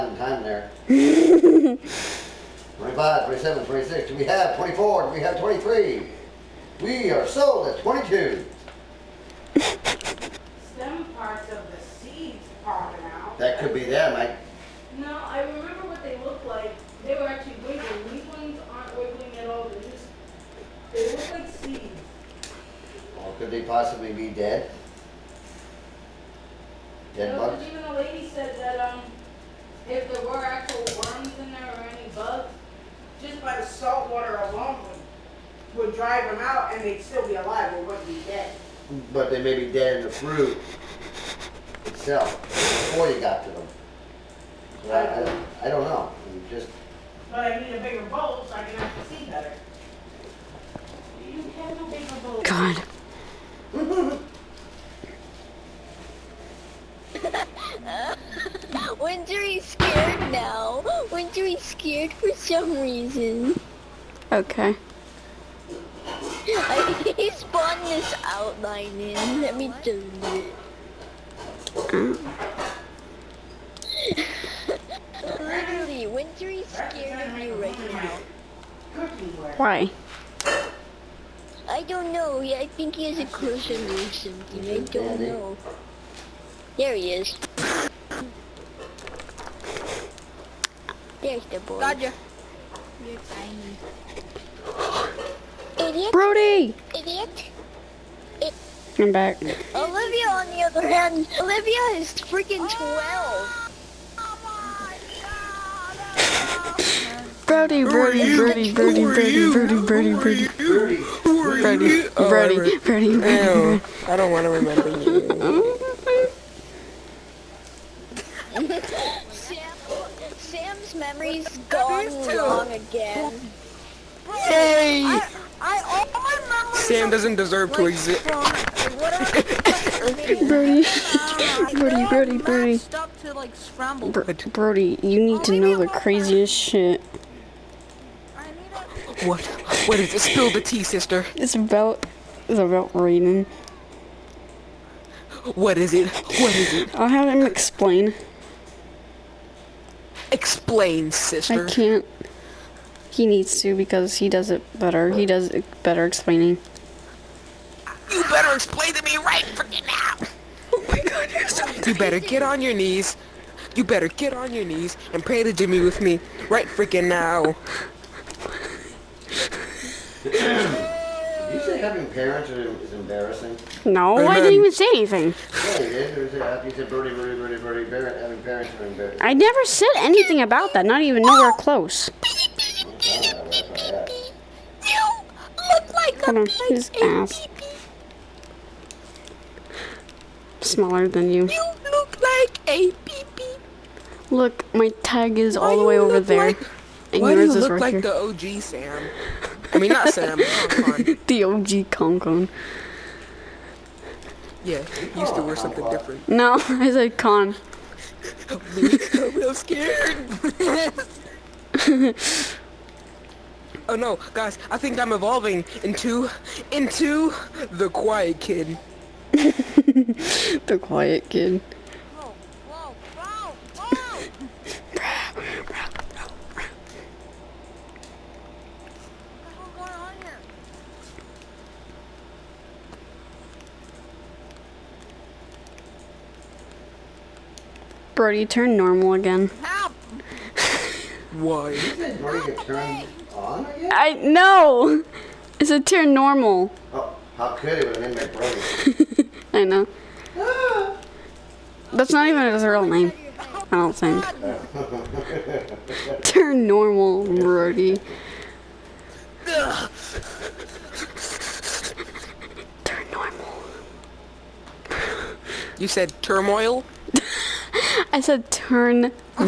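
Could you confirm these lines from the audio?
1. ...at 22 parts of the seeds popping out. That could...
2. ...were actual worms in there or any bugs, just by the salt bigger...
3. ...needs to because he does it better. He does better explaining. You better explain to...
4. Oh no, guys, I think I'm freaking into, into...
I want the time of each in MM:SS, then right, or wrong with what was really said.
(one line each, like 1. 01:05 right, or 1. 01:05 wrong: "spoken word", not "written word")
1. 00:07 right
2. 00:30 wrong: "water", not "bigger"
3. 02:33 right
4. 03:33 wrong: "evolving", not "freaking".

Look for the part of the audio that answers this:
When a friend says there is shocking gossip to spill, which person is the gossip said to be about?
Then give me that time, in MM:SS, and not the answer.
02:22.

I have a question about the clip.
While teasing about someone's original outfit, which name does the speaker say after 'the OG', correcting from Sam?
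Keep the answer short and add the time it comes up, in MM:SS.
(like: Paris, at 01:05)
Concon, at 03:21.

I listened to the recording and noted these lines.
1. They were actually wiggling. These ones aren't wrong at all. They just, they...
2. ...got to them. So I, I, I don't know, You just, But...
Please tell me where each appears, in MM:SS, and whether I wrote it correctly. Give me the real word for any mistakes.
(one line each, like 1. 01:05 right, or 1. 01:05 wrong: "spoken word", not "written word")
1. 00:17 wrong: "wiggling", not "wrong"
2. 00:43 right.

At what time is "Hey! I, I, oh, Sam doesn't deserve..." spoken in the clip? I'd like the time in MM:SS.
02:04.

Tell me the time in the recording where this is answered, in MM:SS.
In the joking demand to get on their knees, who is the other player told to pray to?
02:45.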